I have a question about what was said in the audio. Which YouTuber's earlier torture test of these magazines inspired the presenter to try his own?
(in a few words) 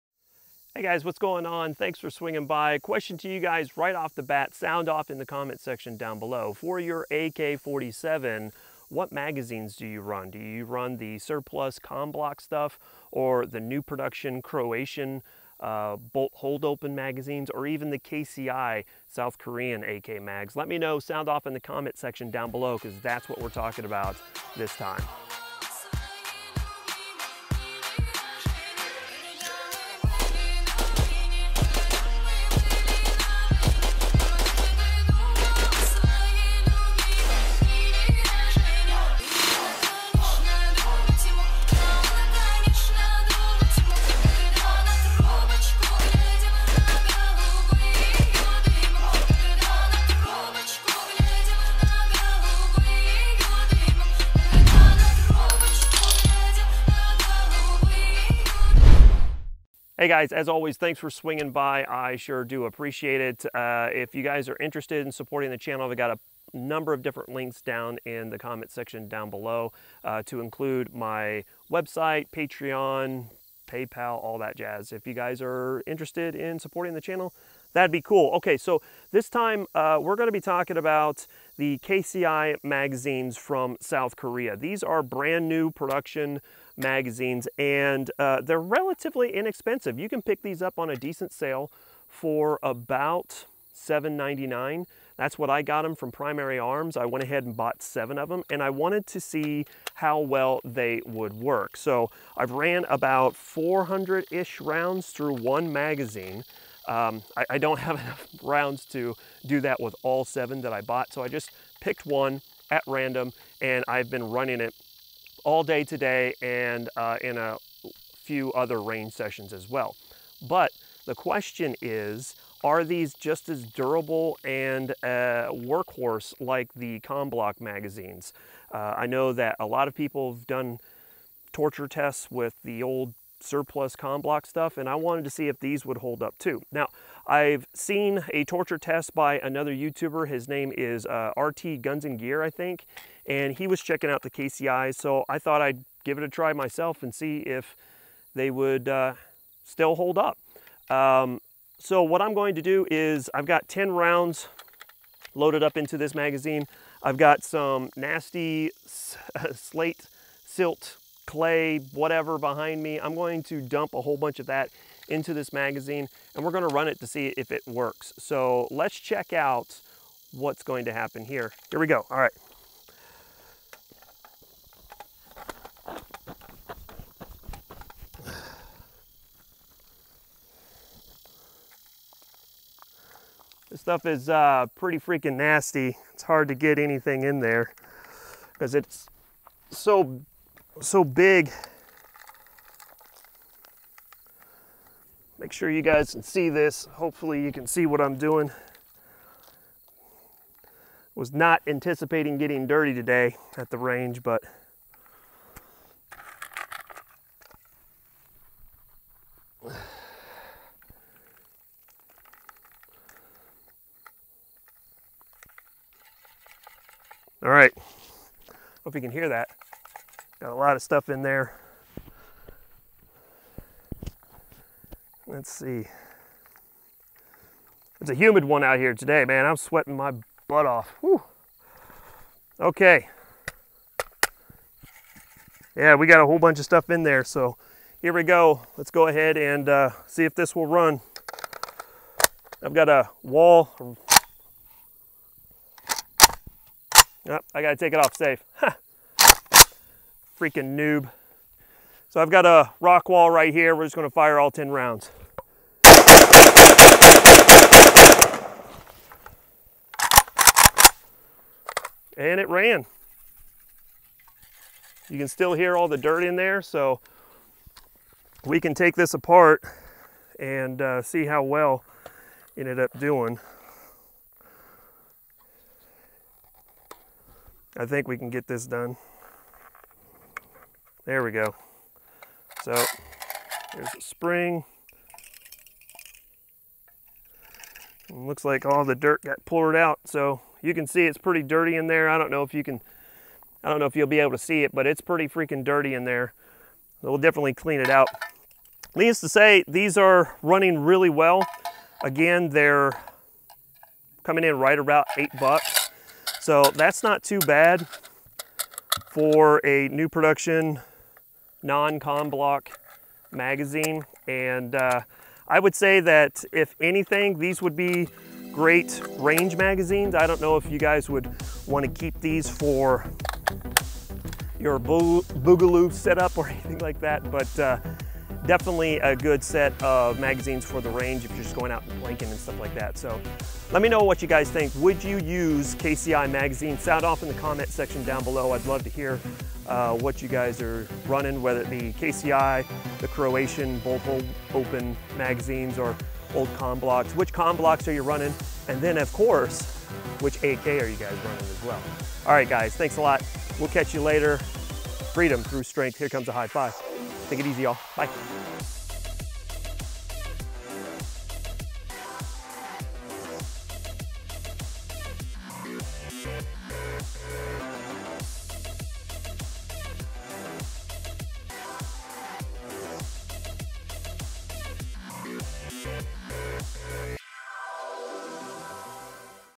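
RT Guns and Gear.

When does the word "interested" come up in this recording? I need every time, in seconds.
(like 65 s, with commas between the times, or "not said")
64 s, 75 s.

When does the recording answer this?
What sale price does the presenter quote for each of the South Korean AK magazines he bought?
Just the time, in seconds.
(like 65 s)
93 s.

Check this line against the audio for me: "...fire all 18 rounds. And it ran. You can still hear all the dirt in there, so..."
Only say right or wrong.
wrong.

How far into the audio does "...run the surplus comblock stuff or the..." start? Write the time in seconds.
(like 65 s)
10 s.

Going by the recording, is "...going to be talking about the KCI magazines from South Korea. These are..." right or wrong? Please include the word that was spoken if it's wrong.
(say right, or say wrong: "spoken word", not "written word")
right.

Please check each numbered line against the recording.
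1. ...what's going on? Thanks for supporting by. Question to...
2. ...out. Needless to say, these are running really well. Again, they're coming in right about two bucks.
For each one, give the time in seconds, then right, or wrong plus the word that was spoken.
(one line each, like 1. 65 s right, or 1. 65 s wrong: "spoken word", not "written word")
1. 1 s wrong: "swinging", not "supporting"
2. 297 s wrong: "eight", not "two".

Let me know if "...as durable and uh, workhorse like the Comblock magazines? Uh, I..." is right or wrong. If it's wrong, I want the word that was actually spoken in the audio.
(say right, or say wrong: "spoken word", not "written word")
right.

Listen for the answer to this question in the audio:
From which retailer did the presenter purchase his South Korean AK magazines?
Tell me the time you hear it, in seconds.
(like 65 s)
96 s.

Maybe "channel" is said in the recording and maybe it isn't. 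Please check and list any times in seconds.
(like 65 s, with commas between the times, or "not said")
65 s, 77 s.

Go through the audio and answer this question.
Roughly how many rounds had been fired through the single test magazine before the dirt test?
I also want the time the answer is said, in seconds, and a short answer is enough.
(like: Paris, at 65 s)
400, at 103 s.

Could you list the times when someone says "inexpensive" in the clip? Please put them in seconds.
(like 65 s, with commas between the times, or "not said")
89 s.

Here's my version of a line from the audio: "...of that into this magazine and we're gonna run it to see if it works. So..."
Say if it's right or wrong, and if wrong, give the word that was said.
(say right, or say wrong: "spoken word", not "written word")
right.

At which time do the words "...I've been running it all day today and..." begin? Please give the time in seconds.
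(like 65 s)
113 s.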